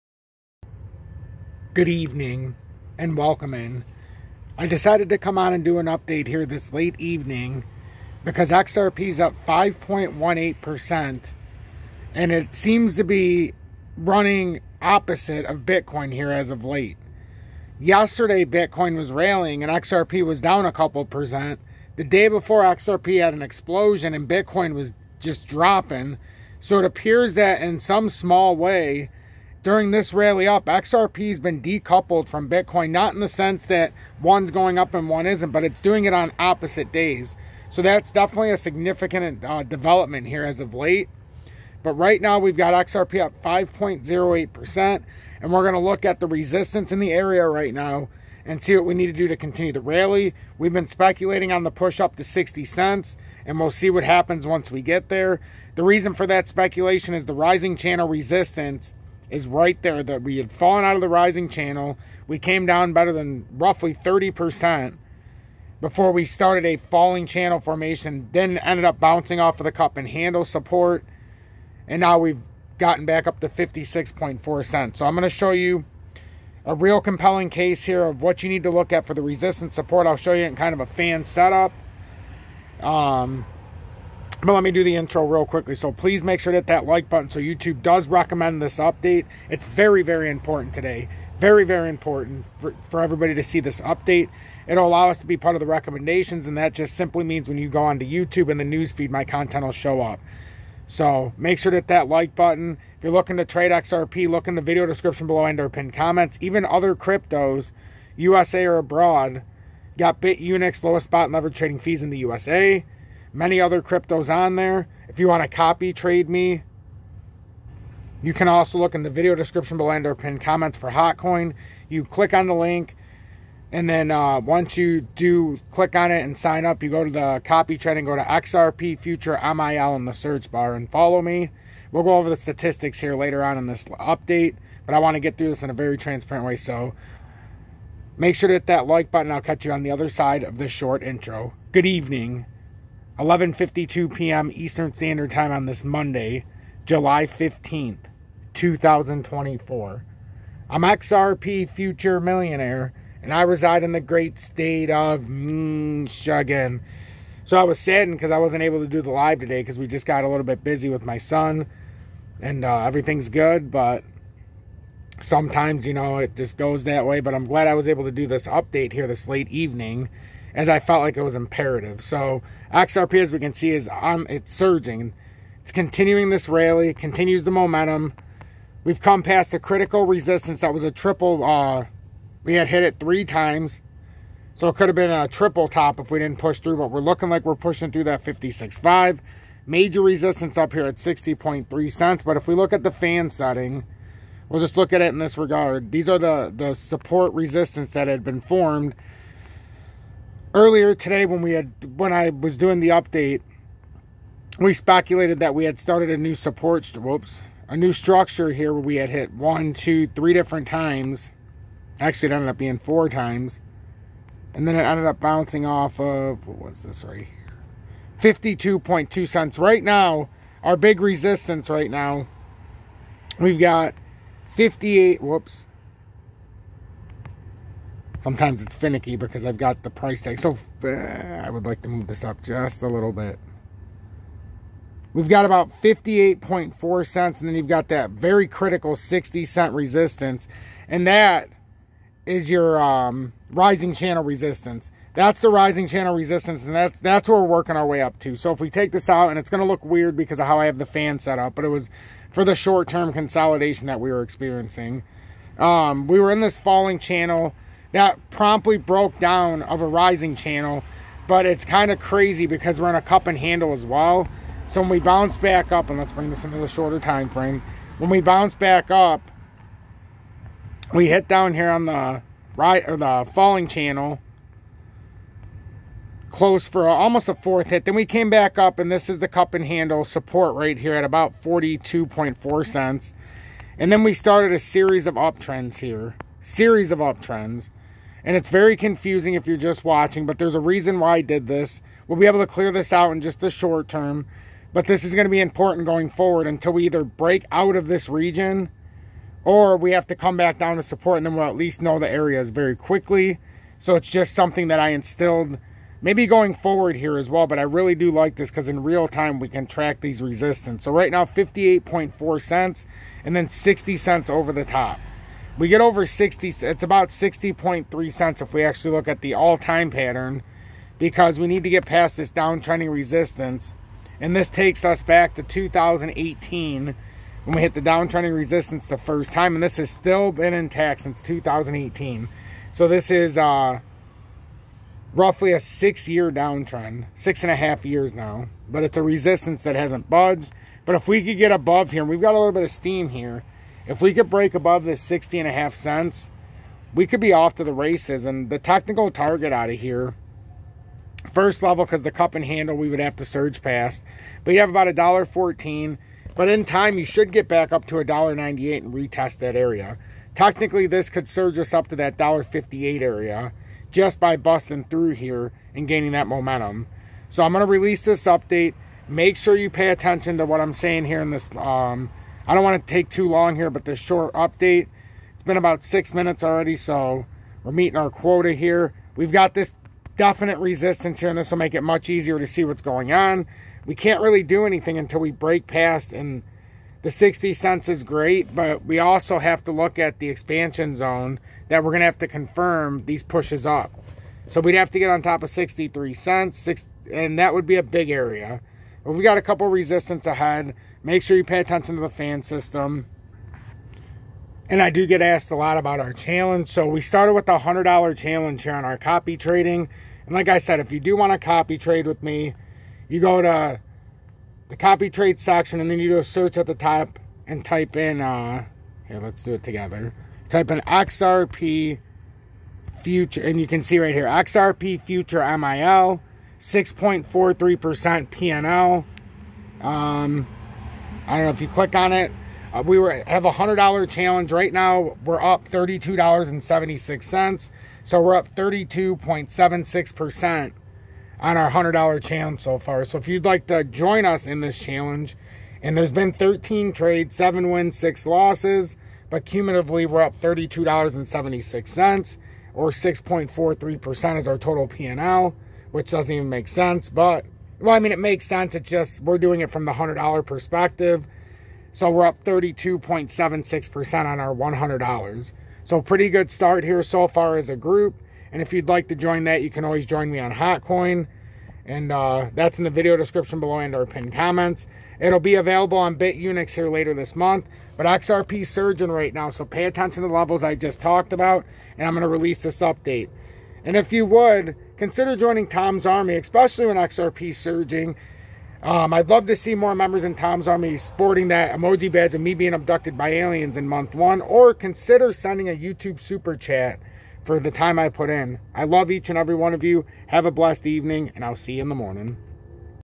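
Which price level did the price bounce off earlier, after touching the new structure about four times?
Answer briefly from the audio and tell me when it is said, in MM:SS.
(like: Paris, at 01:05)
52.2 cents, at 03:38.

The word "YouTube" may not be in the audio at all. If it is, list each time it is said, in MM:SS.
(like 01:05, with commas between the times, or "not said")
01:27, 01:38, 08:15.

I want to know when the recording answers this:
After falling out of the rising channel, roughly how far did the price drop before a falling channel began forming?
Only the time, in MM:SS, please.
01:03.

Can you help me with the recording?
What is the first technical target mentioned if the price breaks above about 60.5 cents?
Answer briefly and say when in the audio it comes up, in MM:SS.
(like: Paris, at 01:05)
$1.14, at 05:54.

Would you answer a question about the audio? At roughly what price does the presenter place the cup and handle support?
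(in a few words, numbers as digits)
42.4 cents.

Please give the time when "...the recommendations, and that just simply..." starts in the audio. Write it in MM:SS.
01:35.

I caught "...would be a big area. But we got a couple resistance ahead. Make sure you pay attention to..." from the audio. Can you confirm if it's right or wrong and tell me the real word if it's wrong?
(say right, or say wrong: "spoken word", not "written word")
right.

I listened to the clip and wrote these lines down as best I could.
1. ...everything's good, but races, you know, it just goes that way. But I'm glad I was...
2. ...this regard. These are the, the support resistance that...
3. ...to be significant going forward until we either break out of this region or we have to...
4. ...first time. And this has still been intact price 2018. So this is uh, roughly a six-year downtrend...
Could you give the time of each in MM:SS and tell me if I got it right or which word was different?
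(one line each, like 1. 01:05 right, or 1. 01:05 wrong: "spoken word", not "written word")
1. 02:42 wrong: "sometimes", not "races"
2. 03:15 right
3. 04:55 wrong: "important", not "significant"
4. 05:28 wrong: "since", not "price".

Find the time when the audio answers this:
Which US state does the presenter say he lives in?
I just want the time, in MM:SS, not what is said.
02:35.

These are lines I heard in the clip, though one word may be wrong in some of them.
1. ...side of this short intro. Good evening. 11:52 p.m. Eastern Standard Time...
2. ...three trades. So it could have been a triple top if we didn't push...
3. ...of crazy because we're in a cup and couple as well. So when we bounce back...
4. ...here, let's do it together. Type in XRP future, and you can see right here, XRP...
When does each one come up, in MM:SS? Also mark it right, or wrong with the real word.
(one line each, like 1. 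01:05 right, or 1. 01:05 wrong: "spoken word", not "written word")
1. 02:20 right
2. 03:02 wrong: "times", not "trades"
3. 04:21 wrong: "handle", not "couple"
4. 06:59 right.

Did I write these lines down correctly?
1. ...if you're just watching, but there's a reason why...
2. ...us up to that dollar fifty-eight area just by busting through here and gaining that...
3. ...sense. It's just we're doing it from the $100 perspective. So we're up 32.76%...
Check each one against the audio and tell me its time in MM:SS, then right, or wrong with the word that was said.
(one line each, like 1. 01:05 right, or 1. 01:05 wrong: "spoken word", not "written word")
1. 04:49 right
2. 06:01 right
3. 07:38 right.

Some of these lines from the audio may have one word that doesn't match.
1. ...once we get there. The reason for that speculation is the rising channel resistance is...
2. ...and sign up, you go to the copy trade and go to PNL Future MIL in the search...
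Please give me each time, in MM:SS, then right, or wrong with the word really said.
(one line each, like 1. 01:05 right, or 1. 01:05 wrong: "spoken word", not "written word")
1. 00:54 right
2. 02:06 wrong: "XRP", not "PNL".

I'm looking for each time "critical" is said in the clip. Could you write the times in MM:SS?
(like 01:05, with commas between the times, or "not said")
02:59, 03:58.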